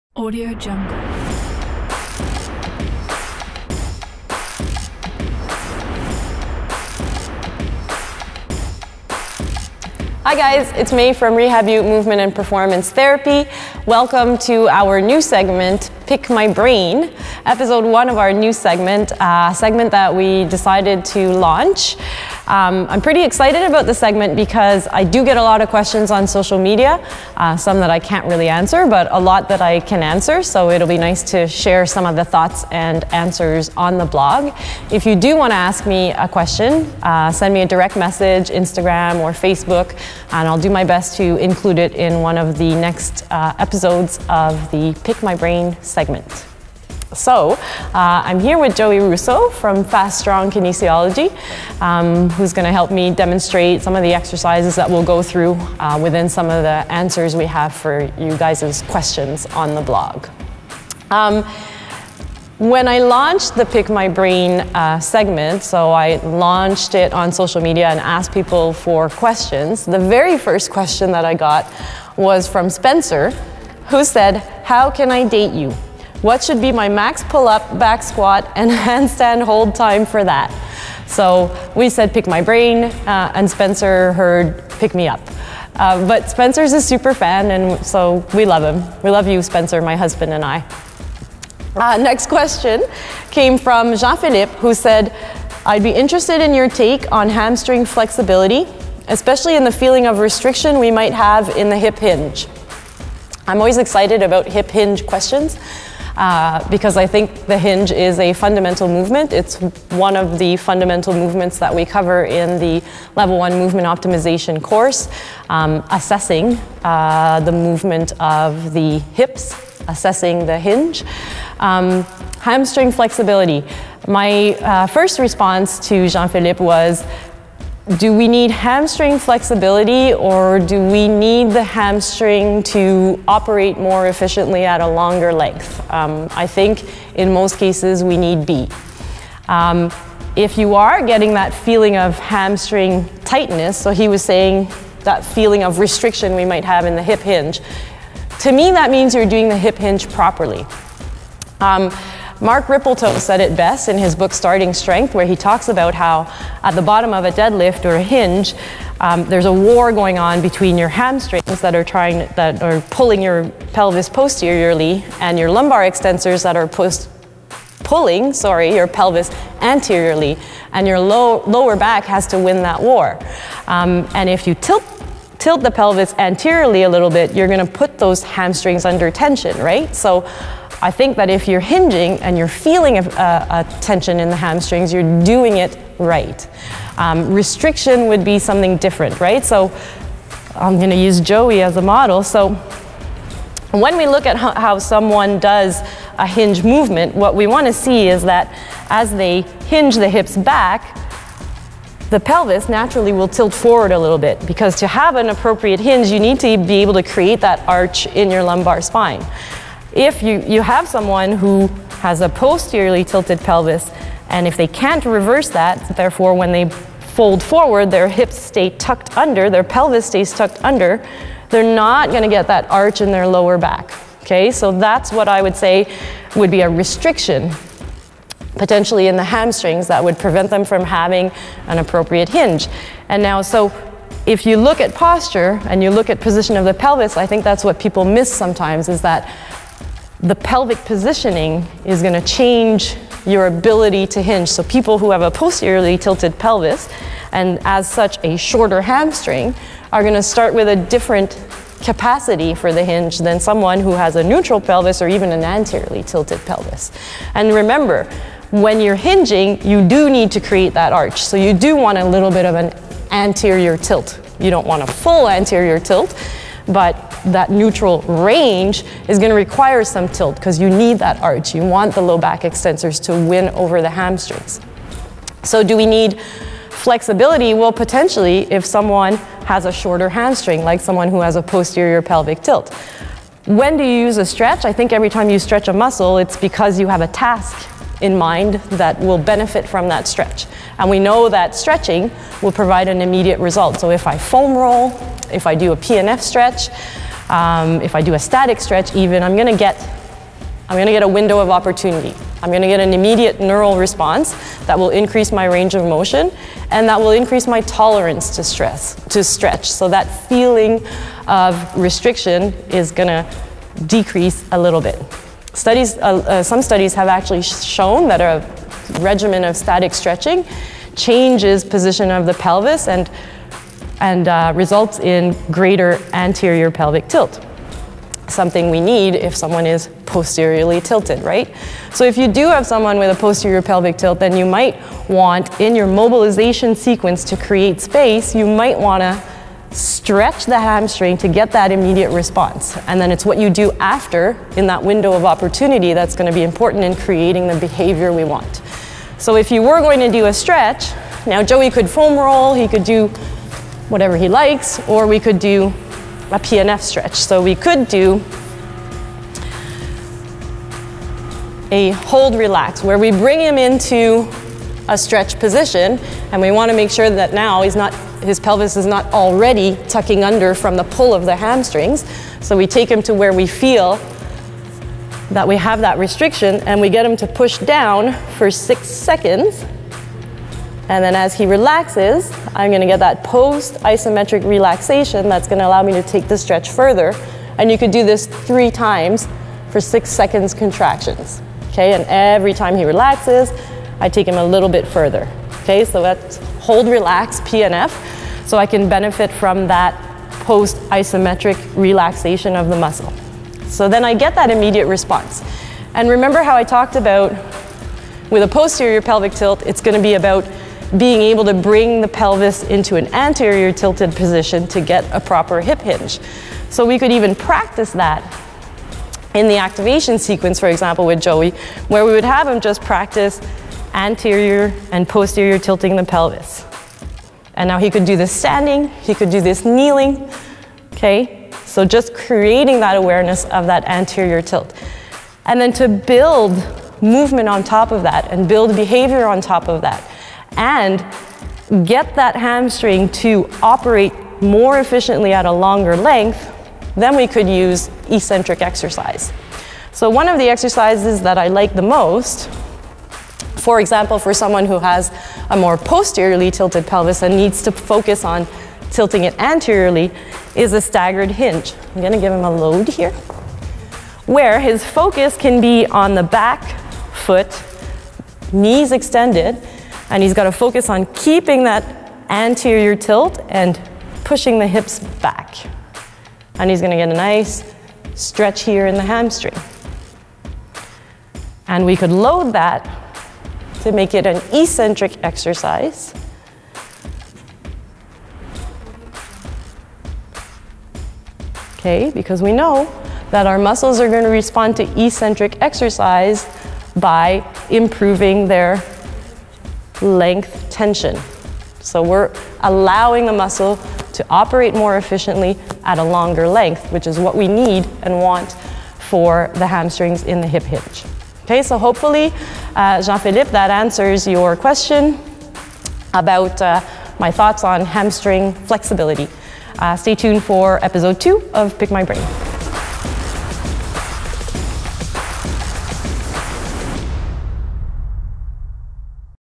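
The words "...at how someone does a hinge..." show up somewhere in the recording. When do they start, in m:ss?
3:14.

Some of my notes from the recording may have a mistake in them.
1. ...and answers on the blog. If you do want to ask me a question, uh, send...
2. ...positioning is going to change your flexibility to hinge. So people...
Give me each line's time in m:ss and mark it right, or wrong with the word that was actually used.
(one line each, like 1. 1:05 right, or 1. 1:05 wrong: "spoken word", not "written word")
1. 0:32 right
2. 4:00 wrong: "ability", not "flexibility".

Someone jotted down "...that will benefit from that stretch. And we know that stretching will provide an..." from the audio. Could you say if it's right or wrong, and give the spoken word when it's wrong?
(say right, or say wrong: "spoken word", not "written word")
right.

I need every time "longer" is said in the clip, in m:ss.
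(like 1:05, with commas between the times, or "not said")
2:14, 7:25, 8:26.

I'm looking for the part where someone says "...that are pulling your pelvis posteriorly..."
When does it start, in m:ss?
2:42.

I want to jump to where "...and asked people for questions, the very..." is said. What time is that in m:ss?
1:07.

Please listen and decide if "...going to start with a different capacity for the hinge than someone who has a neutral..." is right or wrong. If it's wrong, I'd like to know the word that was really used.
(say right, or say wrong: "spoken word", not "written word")
right.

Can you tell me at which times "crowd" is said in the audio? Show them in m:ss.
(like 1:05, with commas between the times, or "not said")
not said.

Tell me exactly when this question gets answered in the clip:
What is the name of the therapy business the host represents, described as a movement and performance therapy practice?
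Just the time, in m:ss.
0:11.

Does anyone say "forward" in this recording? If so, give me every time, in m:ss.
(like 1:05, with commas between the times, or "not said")
3:23, 3:37.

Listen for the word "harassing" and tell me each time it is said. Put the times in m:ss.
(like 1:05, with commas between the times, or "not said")
not said.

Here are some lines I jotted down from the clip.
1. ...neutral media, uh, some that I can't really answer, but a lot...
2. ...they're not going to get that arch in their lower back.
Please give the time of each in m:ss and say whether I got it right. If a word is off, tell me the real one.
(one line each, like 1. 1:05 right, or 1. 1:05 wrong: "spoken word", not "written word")
1. 0:26 wrong: "social", not "neutral"
2. 3:41 right.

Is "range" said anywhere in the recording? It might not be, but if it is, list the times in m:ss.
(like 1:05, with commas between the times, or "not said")
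4:28, 5:05.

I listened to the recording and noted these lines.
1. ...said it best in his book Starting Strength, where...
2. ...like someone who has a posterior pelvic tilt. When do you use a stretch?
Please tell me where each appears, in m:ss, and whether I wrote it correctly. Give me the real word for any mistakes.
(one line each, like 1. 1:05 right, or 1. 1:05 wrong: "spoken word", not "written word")
1. 2:33 right
2. 4:40 right.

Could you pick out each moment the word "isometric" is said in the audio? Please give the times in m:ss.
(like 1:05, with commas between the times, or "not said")
6:23, 6:40.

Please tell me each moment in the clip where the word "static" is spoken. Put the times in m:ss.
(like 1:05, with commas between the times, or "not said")
4:58, 5:19.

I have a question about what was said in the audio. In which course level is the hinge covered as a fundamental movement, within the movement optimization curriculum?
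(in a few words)
level one.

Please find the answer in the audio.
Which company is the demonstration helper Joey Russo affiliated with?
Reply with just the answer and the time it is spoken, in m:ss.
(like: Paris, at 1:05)
Fast Strong Kinesiology, at 0:49.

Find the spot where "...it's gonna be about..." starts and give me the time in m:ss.
6:49.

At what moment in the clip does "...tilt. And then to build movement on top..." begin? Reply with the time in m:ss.
7:14.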